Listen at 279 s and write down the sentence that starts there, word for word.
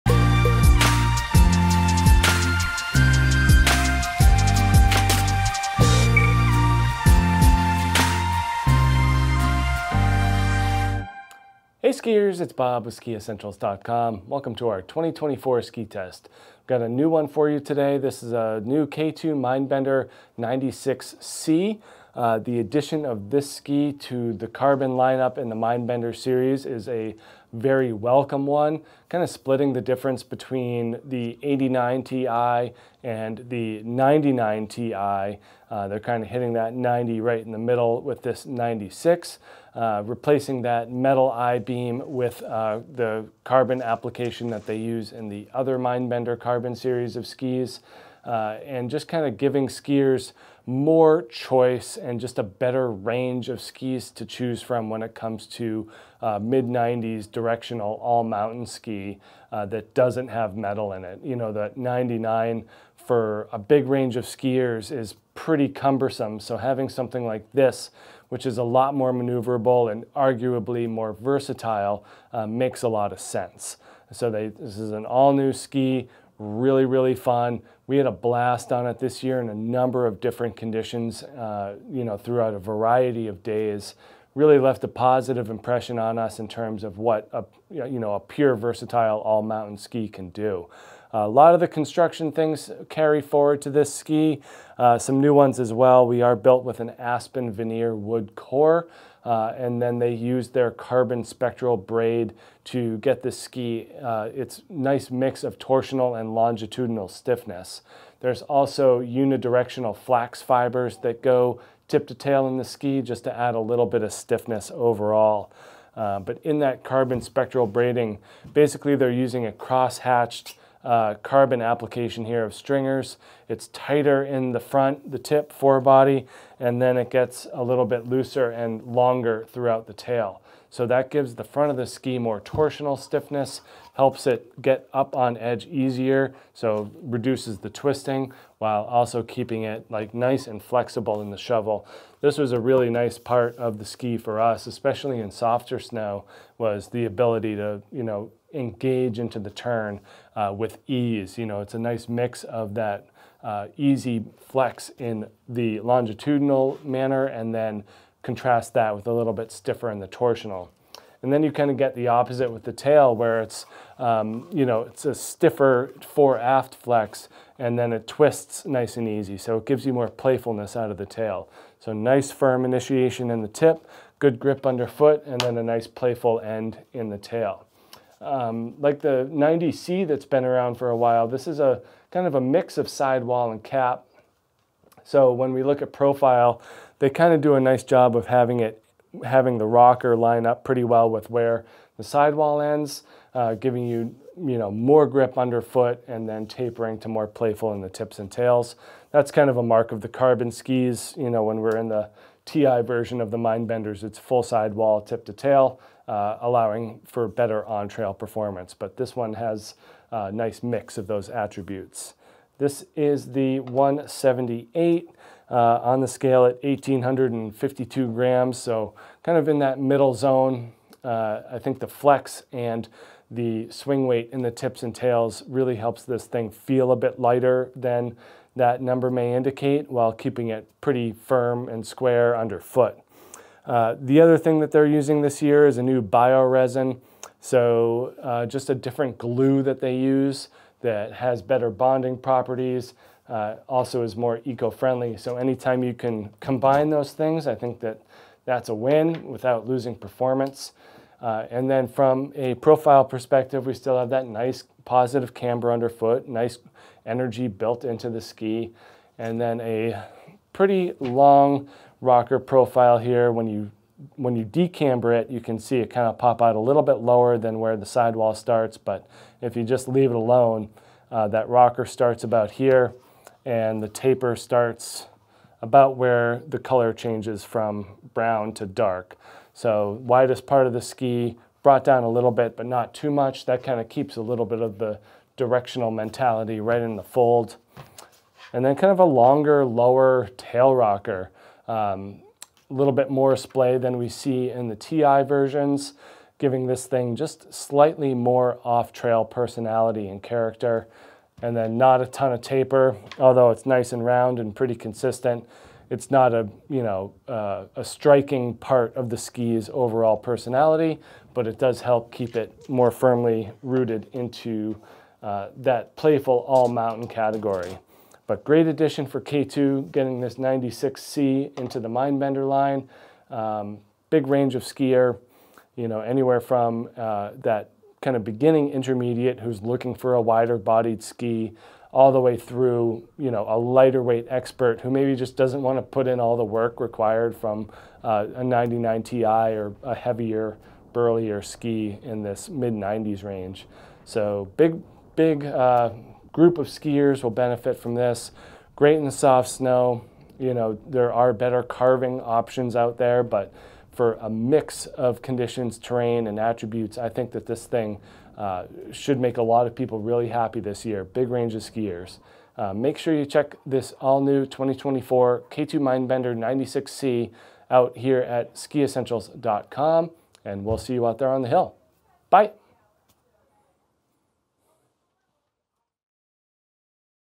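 So widest part of the ski brought down a little bit, but not too much.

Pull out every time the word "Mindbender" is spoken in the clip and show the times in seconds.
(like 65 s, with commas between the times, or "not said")
19 s, 25 s, 45 s, 203 s, 321 s, 365 s.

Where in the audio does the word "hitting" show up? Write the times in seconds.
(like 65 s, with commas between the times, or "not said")
36 s.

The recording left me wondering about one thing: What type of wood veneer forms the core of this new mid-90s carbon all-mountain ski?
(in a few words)
aspen.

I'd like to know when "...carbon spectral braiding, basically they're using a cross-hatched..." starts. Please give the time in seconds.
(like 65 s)
116 s.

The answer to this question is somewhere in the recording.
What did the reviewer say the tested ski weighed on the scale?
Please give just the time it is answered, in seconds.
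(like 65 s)
216 s.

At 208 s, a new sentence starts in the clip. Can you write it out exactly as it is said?
But this one has a nice mix of those attributes.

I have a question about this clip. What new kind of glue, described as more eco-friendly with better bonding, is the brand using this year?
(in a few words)
bioresin.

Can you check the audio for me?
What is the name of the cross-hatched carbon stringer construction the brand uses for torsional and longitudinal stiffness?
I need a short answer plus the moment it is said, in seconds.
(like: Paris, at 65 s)
carbon spectral braid, at 100 s.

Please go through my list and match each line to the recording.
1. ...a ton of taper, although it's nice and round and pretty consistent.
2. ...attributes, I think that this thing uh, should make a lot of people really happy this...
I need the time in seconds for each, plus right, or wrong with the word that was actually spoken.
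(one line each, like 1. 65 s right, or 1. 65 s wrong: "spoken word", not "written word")
1. 302 s right
2. 356 s right.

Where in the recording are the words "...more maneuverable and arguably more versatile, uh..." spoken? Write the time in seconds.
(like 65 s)
68 s.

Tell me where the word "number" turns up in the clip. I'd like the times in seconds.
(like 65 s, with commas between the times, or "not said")
79 s, 228 s.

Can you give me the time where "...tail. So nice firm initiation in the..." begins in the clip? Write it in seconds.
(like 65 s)
171 s.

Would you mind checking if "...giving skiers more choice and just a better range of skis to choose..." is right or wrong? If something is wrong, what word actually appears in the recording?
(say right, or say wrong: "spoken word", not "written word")
right.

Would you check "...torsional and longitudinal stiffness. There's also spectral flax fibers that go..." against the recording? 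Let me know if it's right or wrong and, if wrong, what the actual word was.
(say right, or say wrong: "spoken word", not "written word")
wrong: "unidirectional", not "spectral".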